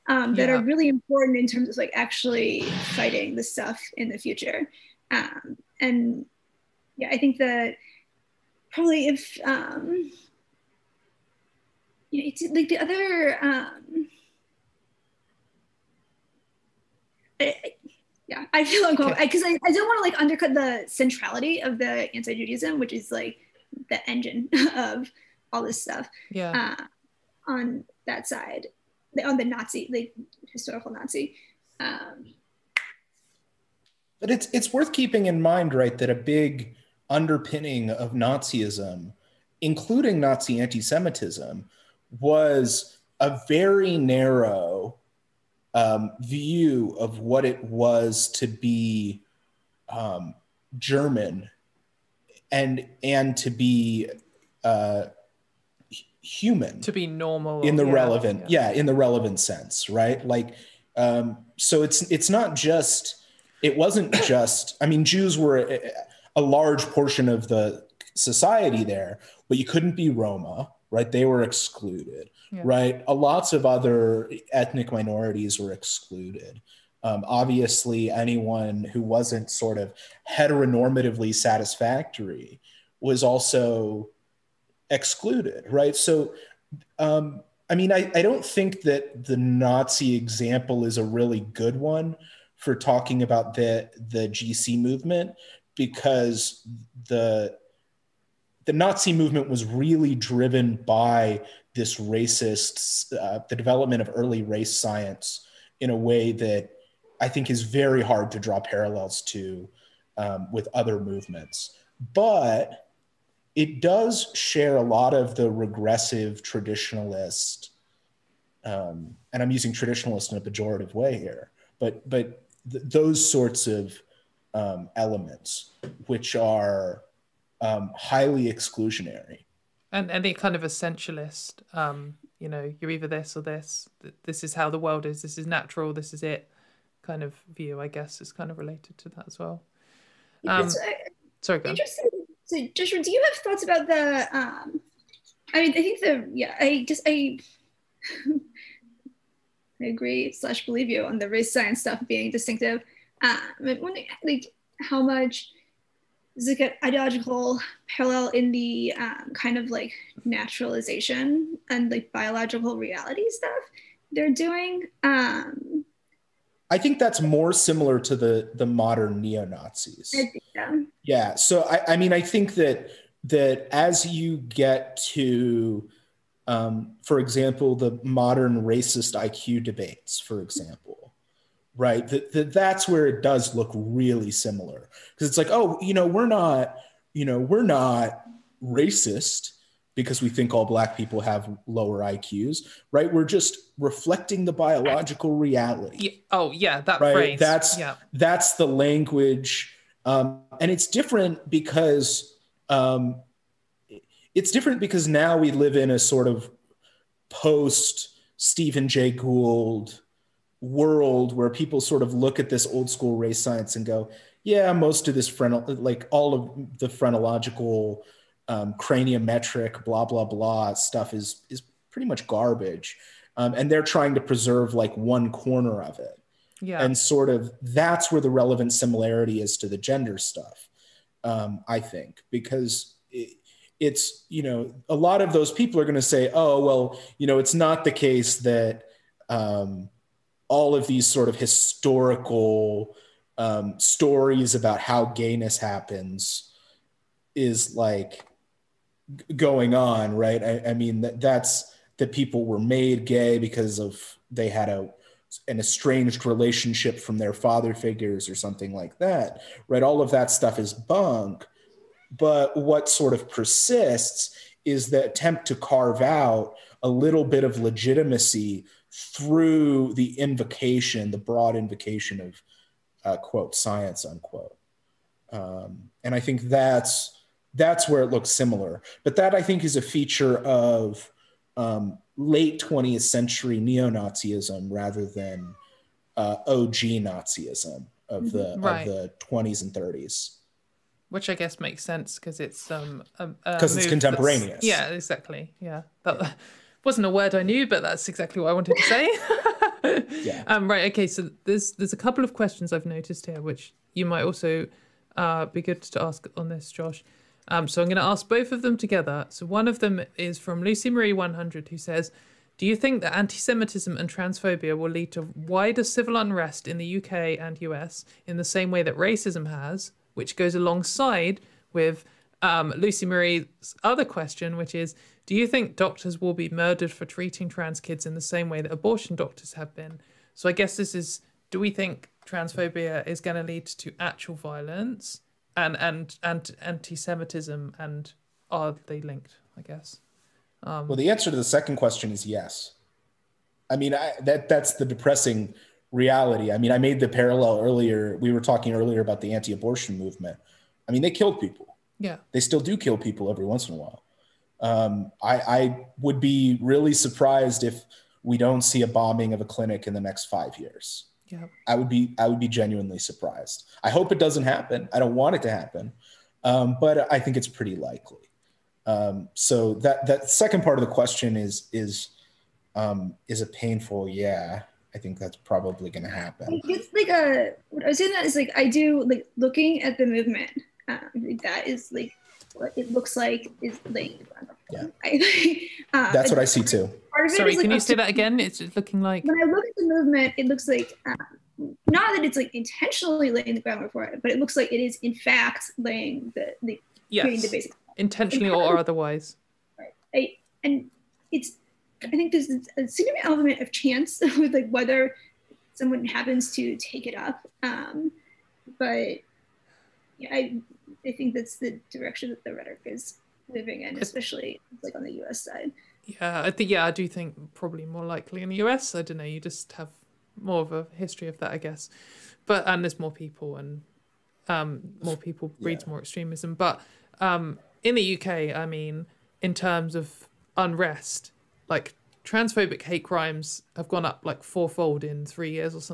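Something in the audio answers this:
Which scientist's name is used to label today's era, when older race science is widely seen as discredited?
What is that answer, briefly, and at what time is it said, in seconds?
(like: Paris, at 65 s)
Stephen Jay Gould, at 208 s.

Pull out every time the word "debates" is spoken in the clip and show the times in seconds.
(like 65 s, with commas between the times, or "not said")
179 s.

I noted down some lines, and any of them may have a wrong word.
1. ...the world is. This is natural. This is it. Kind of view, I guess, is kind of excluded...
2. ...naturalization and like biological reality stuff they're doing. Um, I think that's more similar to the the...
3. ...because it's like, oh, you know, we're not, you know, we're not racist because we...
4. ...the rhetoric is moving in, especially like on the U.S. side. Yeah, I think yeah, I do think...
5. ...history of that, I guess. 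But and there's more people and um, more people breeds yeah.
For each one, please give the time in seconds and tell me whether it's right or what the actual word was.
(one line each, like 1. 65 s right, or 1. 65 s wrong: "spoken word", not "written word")
1. 134 s wrong: "related", not "excluded"
2. 160 s right
3. 185 s right
4. 412 s right
5. 420 s right.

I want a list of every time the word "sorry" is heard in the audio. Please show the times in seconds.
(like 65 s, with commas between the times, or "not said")
141 s, 387 s.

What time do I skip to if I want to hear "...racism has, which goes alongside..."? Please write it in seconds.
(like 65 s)
318 s.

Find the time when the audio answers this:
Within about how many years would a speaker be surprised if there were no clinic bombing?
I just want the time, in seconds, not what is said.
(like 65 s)
360 s.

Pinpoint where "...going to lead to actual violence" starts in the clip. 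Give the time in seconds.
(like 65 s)
333 s.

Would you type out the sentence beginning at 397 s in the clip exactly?
creating the basic intentionally or otherwise.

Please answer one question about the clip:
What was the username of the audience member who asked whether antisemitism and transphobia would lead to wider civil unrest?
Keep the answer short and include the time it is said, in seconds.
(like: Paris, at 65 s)
Lucy Marie 100, at 310 s.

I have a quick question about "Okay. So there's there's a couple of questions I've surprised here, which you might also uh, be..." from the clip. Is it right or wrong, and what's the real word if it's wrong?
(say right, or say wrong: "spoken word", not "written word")
wrong: "noticed", not "surprised".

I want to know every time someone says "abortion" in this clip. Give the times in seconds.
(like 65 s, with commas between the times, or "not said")
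328 s, 349 s.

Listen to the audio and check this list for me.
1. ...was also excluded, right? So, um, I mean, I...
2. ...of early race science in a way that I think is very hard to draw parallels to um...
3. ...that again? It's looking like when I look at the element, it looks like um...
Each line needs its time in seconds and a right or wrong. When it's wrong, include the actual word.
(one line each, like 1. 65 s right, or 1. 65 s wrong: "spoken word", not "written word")
1. 83 s right
2. 104 s right
3. 387 s wrong: "movement", not "element".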